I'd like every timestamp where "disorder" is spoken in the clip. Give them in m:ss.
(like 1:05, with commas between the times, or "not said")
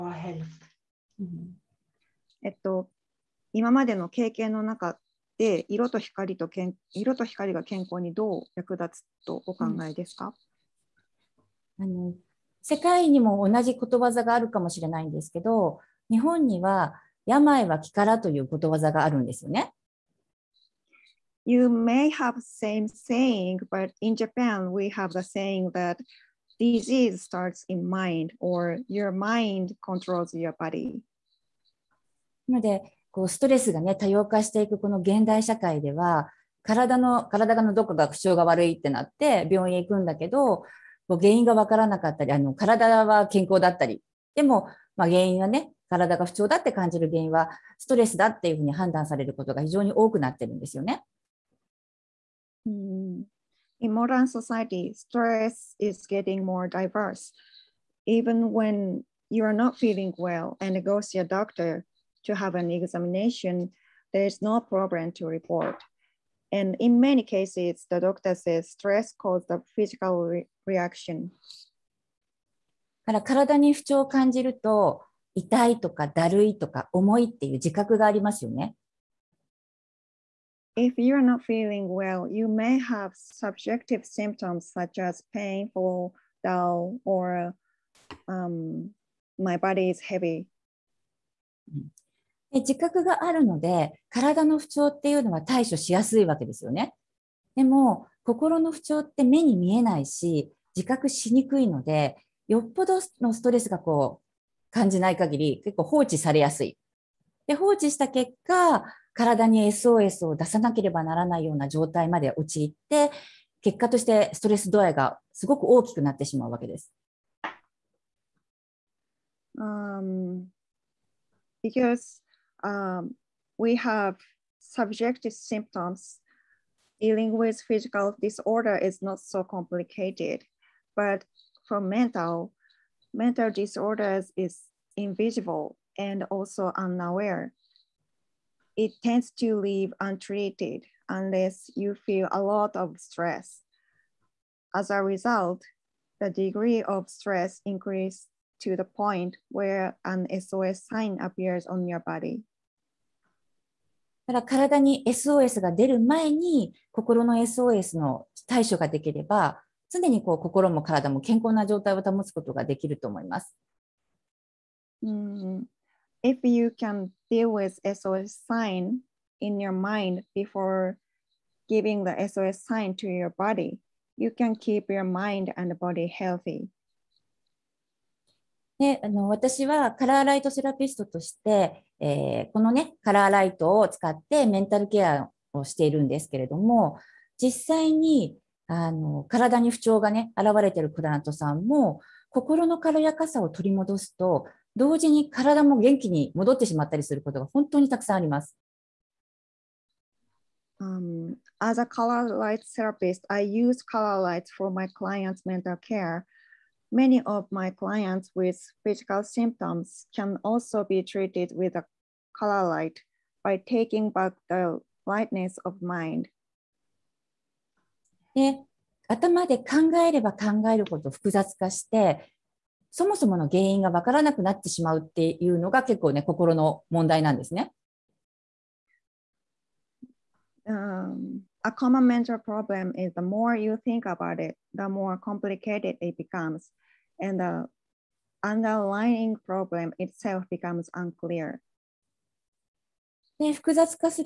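2:08, 2:13.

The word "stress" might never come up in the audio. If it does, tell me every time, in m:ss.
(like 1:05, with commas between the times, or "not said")
0:54, 1:08, 2:22, 2:27.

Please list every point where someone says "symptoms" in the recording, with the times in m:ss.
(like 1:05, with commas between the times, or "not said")
1:24, 2:05, 3:29.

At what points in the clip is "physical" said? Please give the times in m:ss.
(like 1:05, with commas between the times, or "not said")
1:09, 2:07, 3:28.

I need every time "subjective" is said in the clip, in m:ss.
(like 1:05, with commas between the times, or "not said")
1:23, 2:04.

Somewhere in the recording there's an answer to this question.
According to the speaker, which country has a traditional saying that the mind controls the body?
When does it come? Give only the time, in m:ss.
0:24.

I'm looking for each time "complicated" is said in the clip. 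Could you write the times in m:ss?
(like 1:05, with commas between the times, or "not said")
2:09, 3:55.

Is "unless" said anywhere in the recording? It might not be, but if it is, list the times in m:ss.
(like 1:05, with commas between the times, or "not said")
2:21.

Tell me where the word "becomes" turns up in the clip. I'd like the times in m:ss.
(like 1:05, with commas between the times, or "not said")
3:56, 4:00.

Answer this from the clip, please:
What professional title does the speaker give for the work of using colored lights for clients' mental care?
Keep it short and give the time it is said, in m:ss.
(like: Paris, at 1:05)
color light therapist, at 3:21.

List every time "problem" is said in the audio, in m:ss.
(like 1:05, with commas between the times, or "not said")
1:04, 3:52, 3:59.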